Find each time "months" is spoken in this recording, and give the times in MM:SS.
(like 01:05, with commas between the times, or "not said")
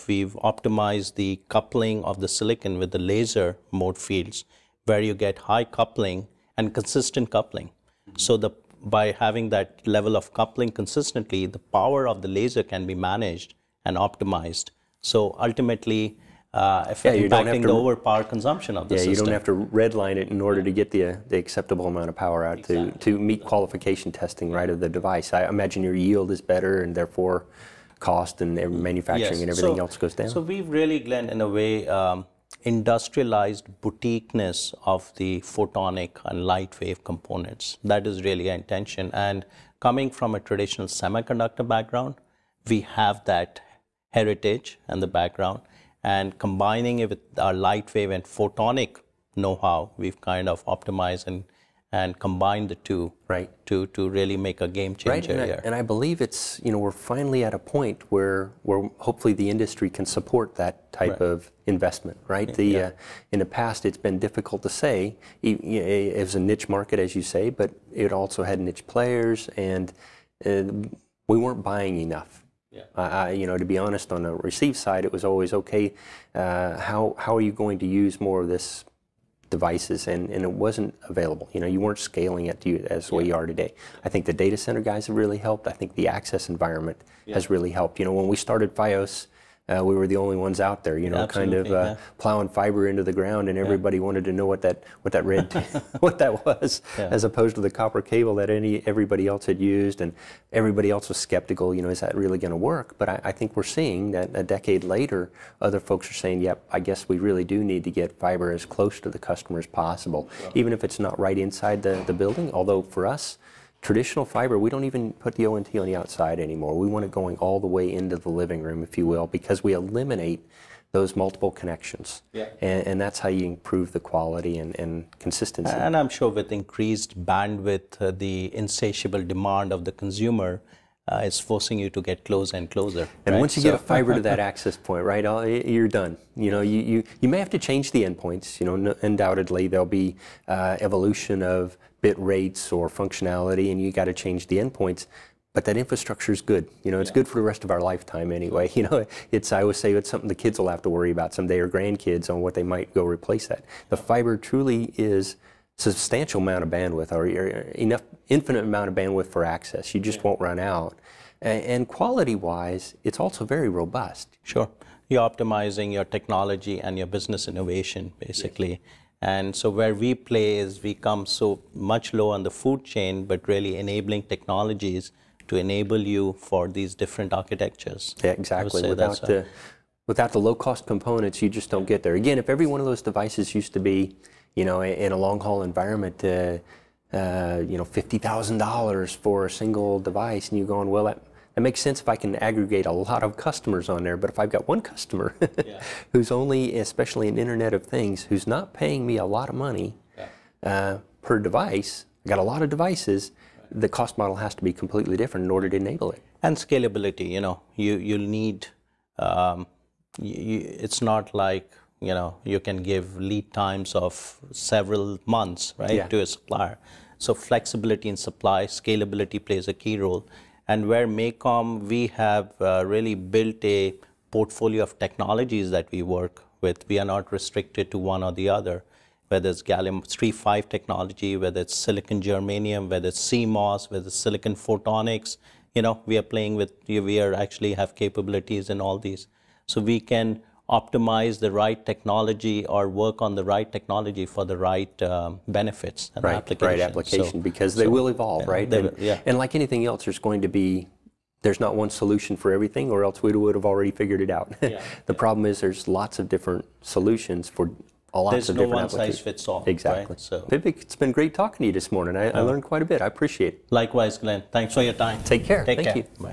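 03:35.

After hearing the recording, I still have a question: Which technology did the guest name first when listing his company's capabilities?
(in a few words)
gallium 3.5.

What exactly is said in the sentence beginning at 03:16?
who's only, especially in Internet of Things, who's not paying me a lot of money yeah.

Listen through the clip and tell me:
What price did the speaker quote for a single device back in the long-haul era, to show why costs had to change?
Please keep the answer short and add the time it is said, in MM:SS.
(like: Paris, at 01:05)
$50,000, at 03:07.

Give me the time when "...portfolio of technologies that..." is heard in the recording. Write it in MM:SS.
03:44.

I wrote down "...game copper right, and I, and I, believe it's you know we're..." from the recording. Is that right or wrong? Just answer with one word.
wrong.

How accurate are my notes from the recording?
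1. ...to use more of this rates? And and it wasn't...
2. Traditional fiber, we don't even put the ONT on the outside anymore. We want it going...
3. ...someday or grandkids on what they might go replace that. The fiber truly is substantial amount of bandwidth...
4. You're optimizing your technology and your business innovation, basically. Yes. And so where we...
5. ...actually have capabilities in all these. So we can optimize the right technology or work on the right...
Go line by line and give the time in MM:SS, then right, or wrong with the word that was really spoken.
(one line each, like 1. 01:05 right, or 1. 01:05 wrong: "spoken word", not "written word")
1. 01:17 wrong: "devices", not "rates"
2. 01:53 right
3. 02:31 right
4. 02:45 right
5. 03:57 right.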